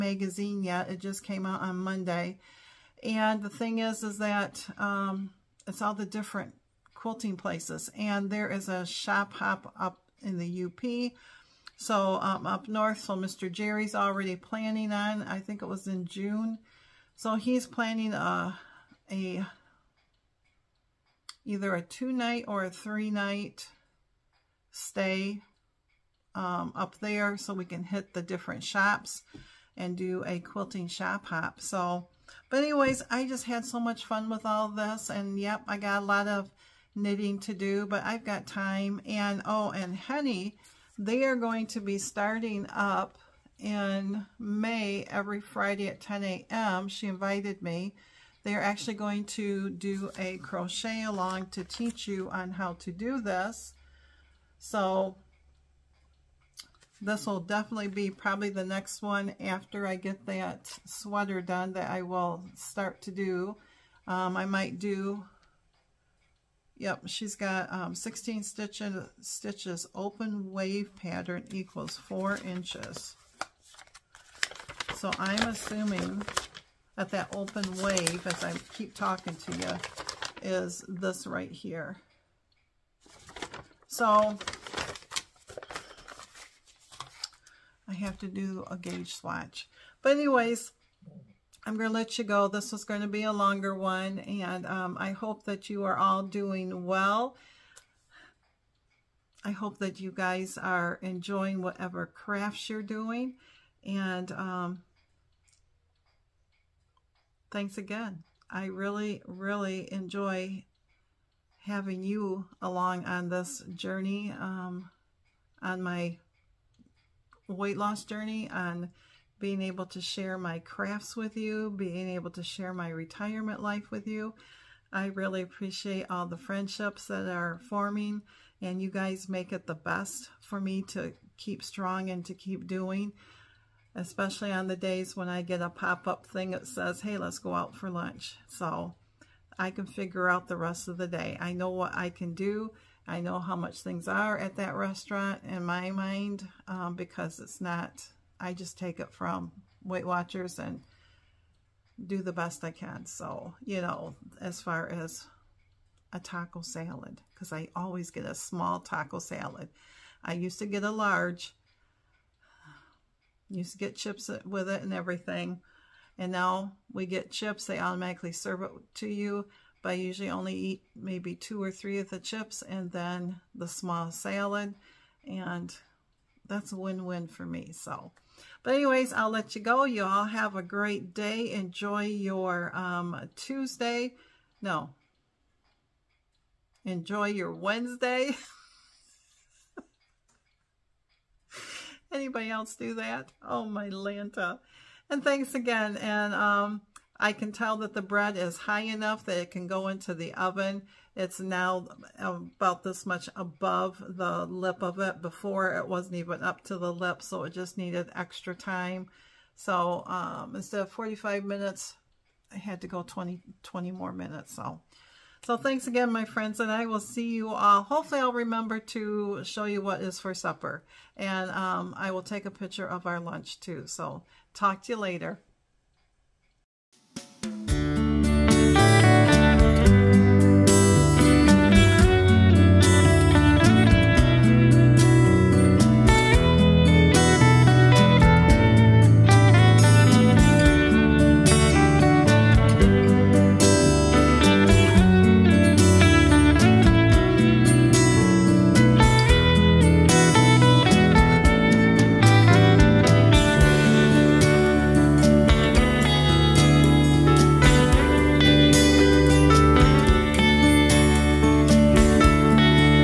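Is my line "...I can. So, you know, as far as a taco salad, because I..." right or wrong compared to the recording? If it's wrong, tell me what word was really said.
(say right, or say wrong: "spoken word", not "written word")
right.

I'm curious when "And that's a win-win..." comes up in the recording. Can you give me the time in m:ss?
2:55.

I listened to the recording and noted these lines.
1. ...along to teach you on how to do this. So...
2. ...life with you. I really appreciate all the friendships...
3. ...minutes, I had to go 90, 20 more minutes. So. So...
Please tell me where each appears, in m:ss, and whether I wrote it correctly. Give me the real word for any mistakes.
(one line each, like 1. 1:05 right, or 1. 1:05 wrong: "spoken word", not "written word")
1. 0:51 right
2. 2:03 right
3. 3:31 wrong: "20", not "90".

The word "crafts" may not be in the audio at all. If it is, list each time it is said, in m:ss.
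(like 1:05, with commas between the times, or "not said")
1:42, 2:00.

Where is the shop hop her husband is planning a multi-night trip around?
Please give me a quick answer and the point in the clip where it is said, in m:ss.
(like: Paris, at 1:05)
The UP, at 0:10.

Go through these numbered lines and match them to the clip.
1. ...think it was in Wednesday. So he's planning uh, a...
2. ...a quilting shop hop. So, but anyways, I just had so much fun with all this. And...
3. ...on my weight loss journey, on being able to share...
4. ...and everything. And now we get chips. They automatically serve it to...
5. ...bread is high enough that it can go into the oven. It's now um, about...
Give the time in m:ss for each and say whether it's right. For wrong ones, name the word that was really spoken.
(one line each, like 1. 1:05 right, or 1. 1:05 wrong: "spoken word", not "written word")
1. 0:15 wrong: "June", not "Wednesday"
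2. 0:30 right
3. 1:55 right
4. 2:44 right
5. 3:18 right.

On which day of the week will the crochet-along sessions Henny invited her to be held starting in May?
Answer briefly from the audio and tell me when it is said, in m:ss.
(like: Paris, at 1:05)
Friday, at 0:45.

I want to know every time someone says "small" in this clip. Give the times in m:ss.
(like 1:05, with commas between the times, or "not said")
2:38, 2:53.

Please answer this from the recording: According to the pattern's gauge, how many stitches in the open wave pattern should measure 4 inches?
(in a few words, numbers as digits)
16.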